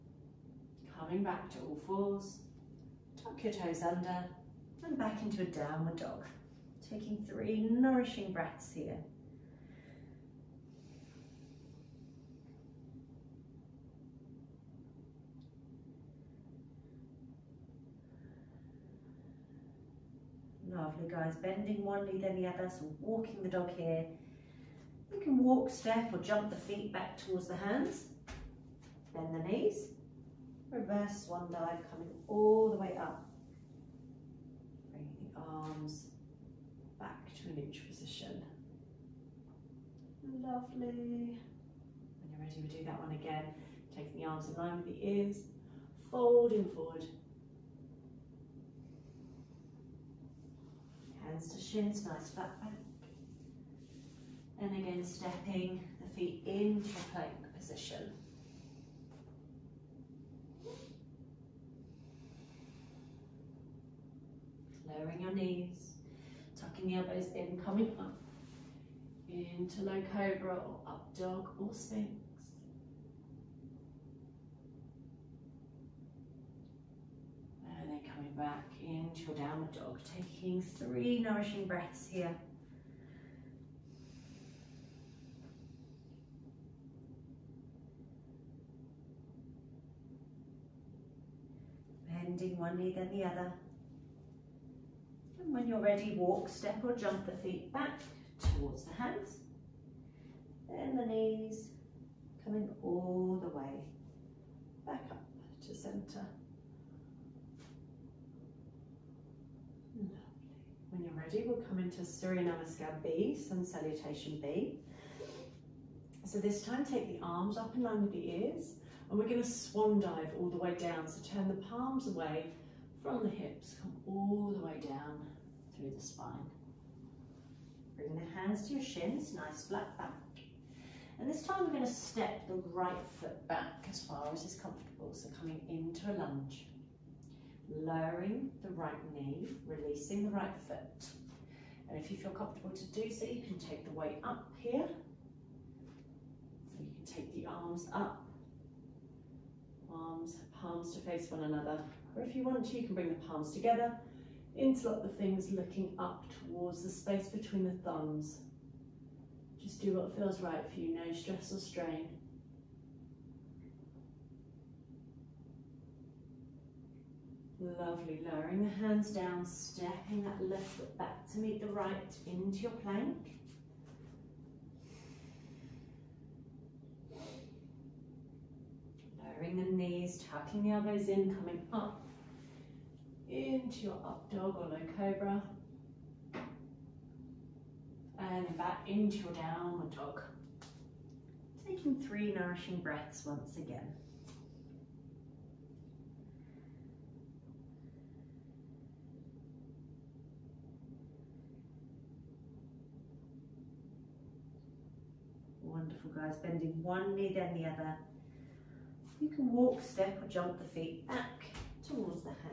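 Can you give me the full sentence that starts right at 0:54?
Then again, stepping the feet into plank position.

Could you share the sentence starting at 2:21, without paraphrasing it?
And if you feel comfortable to do so, you can take the weight up here.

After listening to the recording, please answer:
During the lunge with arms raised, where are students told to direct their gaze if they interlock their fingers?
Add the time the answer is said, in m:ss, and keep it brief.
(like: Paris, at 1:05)
space between the thumbs, at 2:36.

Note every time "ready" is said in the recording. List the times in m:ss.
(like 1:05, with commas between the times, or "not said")
0:42, 1:35, 1:51.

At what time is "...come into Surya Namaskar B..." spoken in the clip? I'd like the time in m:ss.
1:51.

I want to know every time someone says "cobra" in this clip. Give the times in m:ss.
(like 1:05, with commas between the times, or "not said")
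1:10, 3:04.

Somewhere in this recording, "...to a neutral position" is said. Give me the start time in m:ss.
0:37.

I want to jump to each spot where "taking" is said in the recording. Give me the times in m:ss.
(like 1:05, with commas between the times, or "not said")
0:06, 0:43, 1:20, 3:11.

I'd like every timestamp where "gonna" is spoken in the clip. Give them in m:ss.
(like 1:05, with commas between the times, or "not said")
1:59, 2:11.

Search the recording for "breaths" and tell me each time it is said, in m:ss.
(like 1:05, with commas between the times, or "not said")
0:08, 1:21, 3:12.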